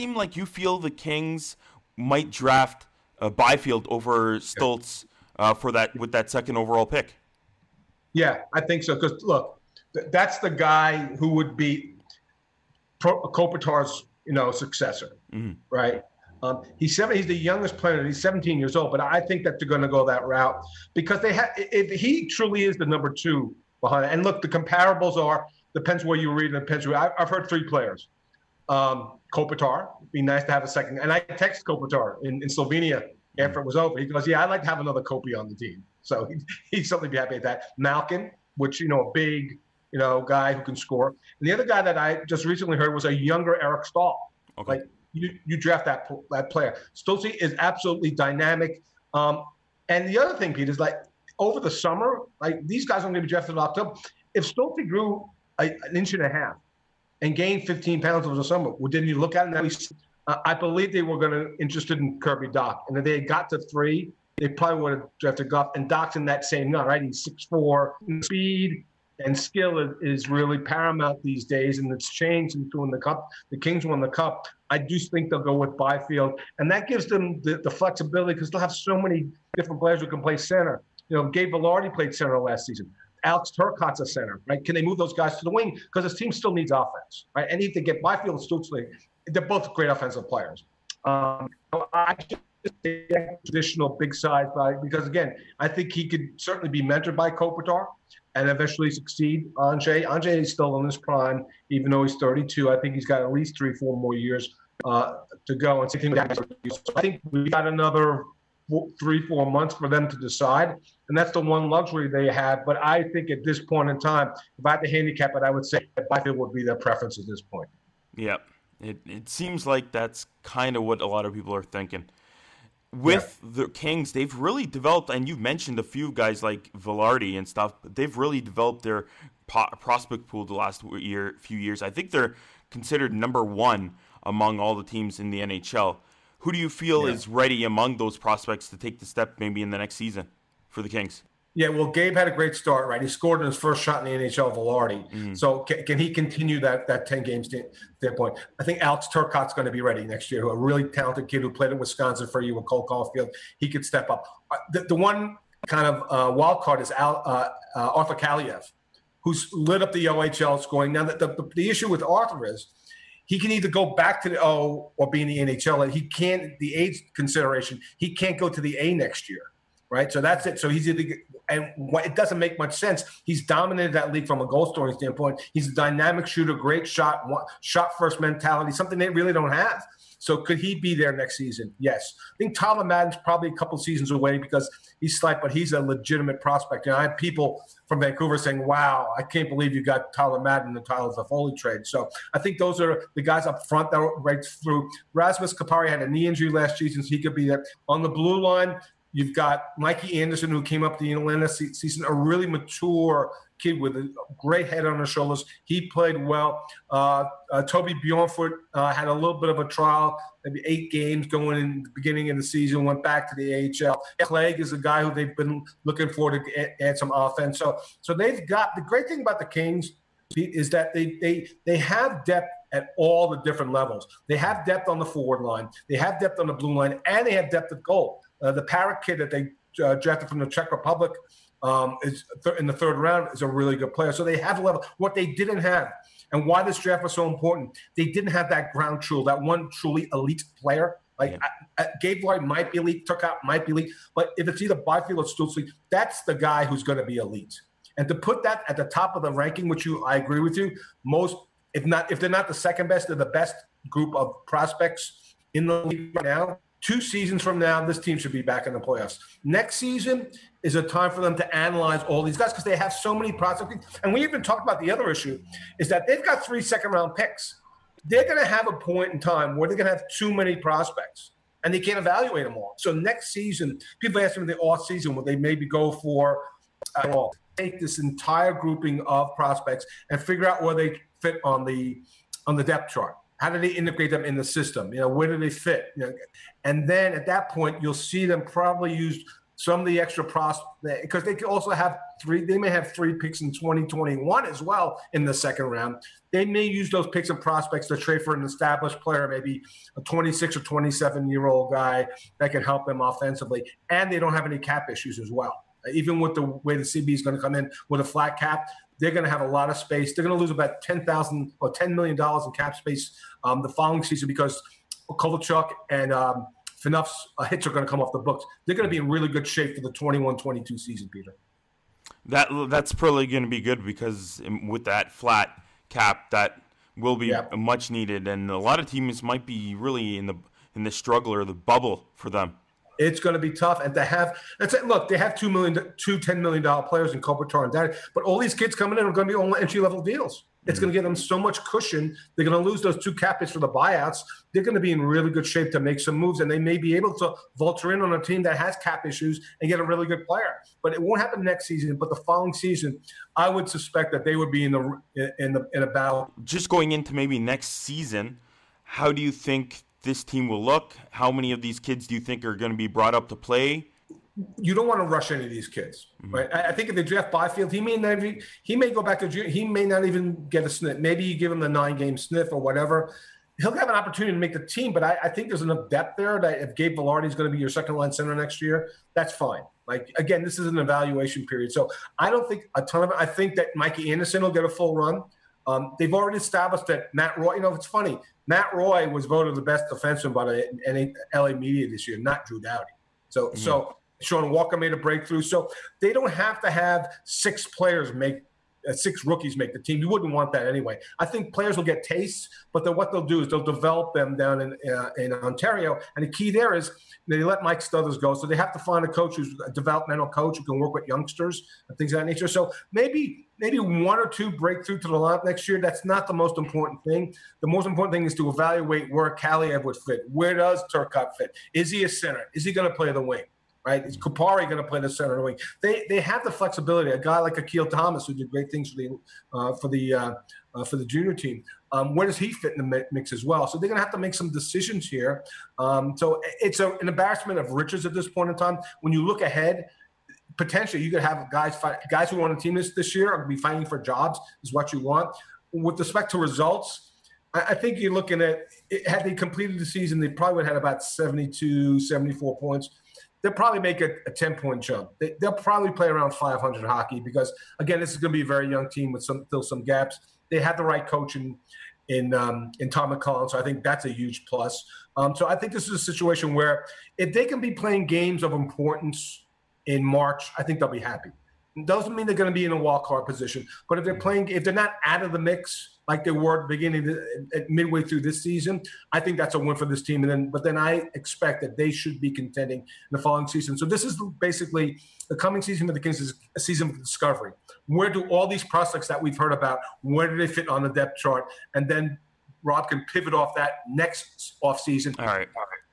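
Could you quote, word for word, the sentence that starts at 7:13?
So they're going to have to make some decisions here.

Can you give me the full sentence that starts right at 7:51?
Doesn't mean they're going to be in a wild card position, but if they're mm-hmm.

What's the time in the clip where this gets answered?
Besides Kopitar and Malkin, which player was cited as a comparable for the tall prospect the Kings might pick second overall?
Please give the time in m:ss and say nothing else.
0:43.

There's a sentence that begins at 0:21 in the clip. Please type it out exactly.
If he truly is the number two behind it.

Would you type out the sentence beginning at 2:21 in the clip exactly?
Yeah, well, Gabe had a great start, right?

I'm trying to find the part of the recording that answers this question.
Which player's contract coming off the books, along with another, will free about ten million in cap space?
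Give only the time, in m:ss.
5:15.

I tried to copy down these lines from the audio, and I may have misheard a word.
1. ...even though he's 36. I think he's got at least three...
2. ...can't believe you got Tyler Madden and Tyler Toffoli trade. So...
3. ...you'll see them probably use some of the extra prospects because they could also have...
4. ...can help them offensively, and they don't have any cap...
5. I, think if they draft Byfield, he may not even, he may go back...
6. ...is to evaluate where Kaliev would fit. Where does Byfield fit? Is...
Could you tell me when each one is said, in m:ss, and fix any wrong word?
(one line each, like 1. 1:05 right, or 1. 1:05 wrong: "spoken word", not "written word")
1. 1:41 wrong: "32", not "36"
2. 3:09 right
3. 4:47 right
4. 5:02 right
5. 6:06 right
6. 6:58 wrong: "Turcotte", not "Byfield".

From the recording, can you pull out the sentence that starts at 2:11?
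I think they're considered number one among all the teams in the NHL.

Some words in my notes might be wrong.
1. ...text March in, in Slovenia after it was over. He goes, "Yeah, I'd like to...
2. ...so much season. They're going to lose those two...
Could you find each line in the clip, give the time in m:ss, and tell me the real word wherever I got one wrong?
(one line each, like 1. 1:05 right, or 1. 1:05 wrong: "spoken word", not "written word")
1. 0:31 wrong: "Kopitar", not "March"
2. 5:41 wrong: "cushion", not "season".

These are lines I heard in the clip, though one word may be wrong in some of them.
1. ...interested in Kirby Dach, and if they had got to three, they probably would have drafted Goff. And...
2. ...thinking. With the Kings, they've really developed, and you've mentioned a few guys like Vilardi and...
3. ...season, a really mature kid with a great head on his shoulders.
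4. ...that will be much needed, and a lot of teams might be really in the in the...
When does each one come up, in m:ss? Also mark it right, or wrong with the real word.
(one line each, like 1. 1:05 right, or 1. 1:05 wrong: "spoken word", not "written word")
1. 1:01 right
2. 2:01 right
3. 3:21 right
4. 5:26 right.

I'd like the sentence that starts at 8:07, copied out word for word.
Where do all these prospects that we've heard about?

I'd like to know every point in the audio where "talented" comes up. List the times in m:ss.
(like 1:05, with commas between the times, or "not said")
2:30.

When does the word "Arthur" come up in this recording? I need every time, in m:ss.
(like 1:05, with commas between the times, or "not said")
2:37, 2:42.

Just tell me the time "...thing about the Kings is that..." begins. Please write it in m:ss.
3:39.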